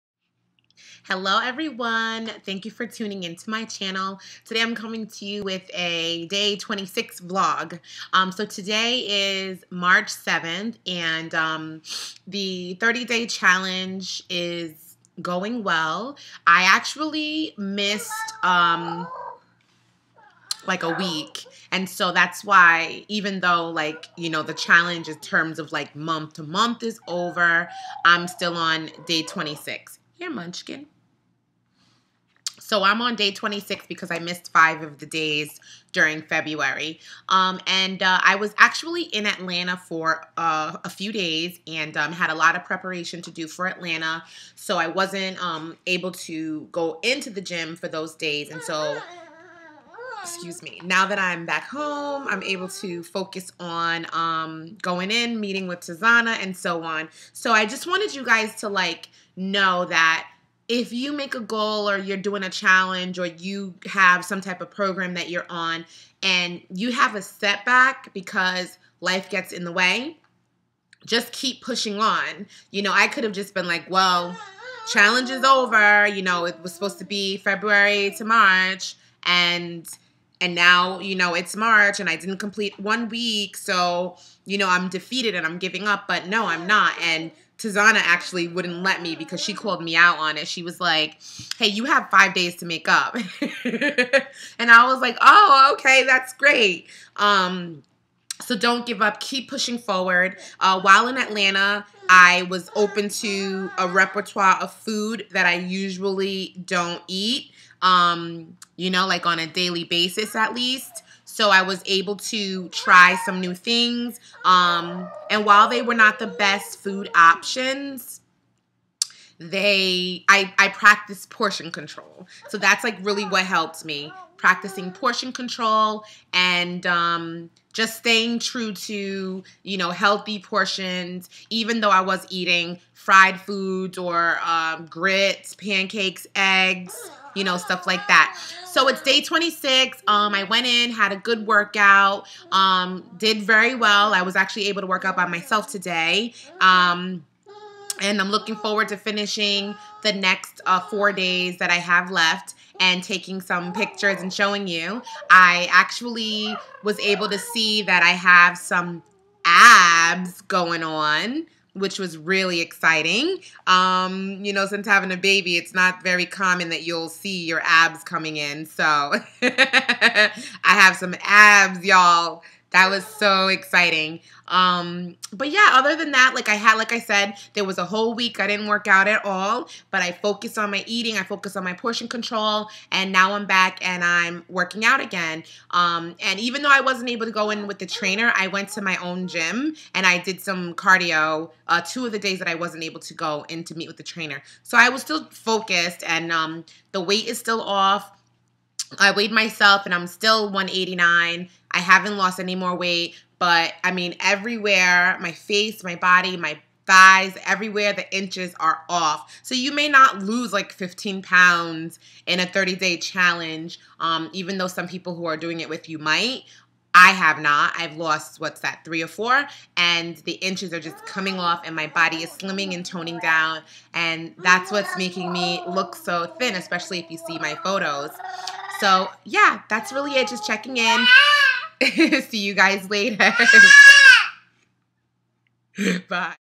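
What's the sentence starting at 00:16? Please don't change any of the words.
I actually missed um, like a week.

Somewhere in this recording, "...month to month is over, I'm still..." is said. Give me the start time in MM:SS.
00:25.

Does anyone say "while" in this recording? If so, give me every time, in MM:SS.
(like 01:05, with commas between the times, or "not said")
01:40, 01:55.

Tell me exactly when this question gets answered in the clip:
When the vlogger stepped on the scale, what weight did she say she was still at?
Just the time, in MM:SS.
03:20.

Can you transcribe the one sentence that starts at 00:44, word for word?
So I wasn't um, able to go into the gym for those days.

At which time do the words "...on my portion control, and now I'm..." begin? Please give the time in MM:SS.
03:01.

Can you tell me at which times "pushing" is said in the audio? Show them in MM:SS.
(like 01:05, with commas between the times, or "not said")
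01:11, 01:39.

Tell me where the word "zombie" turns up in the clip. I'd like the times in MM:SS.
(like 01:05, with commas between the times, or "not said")
not said.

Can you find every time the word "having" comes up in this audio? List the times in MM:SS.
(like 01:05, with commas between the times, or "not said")
02:44.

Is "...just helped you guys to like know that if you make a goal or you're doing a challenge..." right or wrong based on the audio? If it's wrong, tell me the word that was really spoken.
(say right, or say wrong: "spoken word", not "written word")
wrong: "wanted", not "helped".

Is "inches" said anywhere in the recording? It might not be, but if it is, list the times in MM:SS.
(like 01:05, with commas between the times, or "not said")
03:28, 03:40.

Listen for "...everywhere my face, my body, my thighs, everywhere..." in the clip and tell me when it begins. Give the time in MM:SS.
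03:24.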